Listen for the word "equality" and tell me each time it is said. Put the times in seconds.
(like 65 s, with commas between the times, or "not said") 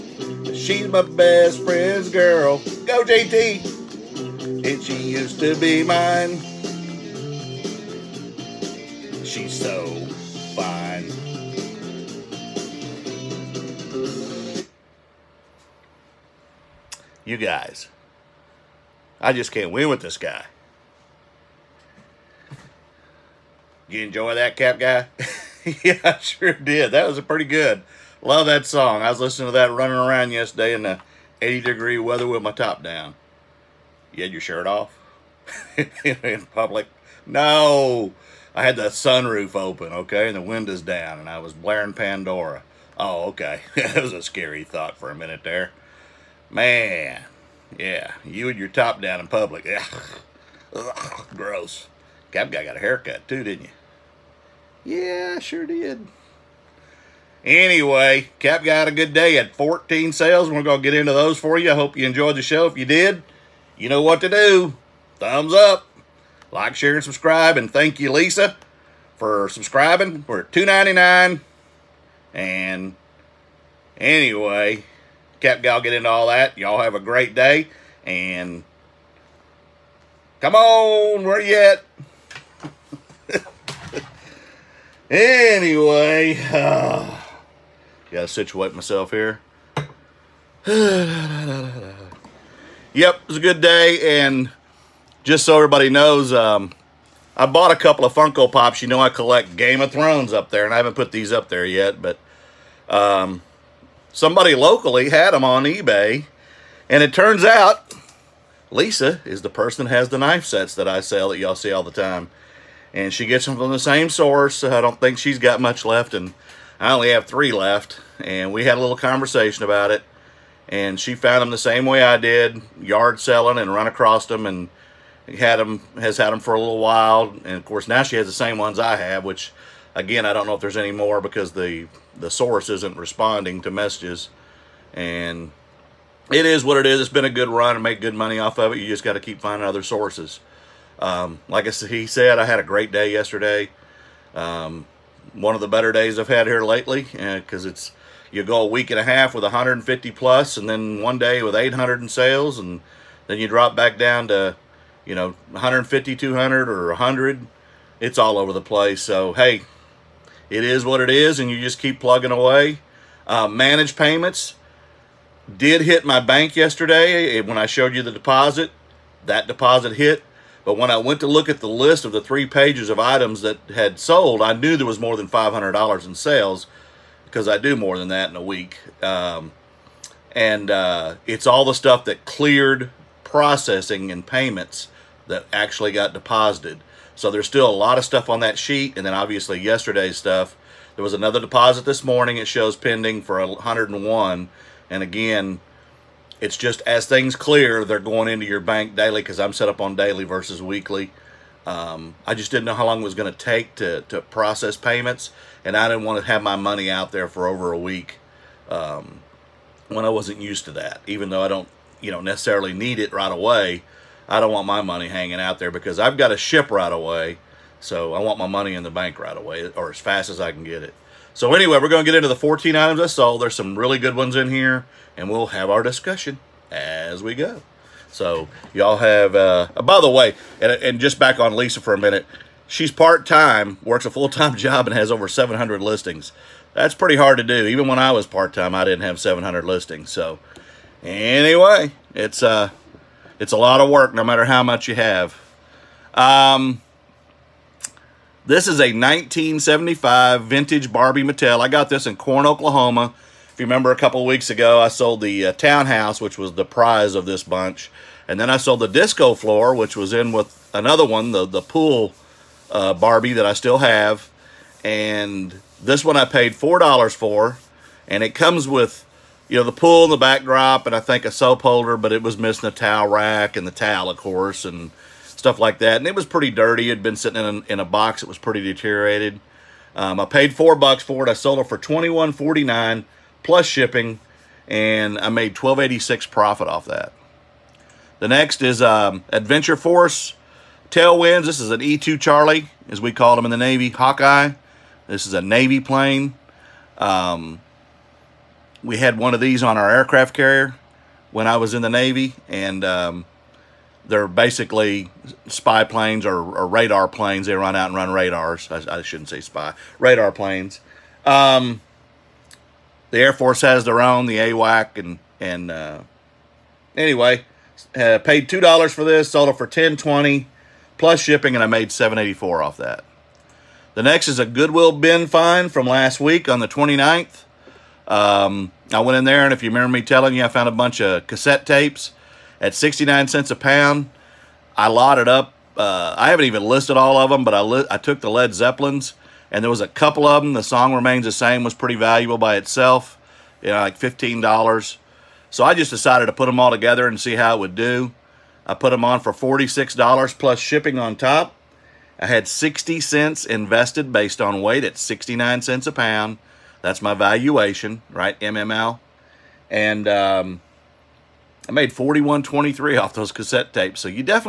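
not said.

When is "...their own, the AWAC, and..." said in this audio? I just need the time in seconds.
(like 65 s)
313 s.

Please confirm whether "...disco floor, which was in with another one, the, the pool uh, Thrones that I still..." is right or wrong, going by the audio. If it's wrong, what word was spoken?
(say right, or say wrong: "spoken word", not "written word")
wrong: "Barbie", not "Thrones".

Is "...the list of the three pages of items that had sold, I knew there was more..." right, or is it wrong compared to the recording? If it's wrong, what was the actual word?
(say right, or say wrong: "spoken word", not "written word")
right.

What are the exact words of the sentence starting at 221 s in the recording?
So anyway, we're going to get into the 14 items I saw.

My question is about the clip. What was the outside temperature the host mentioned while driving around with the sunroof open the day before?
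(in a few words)
80 degrees.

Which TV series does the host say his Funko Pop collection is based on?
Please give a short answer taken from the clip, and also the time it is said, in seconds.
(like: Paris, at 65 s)
Game of Thrones, at 99 s.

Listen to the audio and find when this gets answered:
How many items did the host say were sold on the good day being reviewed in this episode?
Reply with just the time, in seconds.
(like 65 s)
59 s.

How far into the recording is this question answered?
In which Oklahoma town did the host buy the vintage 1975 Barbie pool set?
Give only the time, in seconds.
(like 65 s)
252 s.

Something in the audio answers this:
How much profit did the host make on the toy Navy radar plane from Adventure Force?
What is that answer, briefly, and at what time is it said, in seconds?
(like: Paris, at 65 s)
$7.84, at 321 s.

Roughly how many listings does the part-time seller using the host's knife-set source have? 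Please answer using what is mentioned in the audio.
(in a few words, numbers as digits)
over 700.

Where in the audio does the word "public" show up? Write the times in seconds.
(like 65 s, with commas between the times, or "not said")
36 s, 49 s.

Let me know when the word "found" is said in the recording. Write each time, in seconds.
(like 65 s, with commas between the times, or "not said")
121 s, 330 s.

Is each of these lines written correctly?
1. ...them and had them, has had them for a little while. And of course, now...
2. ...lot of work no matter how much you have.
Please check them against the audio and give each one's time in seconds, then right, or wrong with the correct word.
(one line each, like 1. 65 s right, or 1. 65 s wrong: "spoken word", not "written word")
1. 124 s right
2. 243 s right.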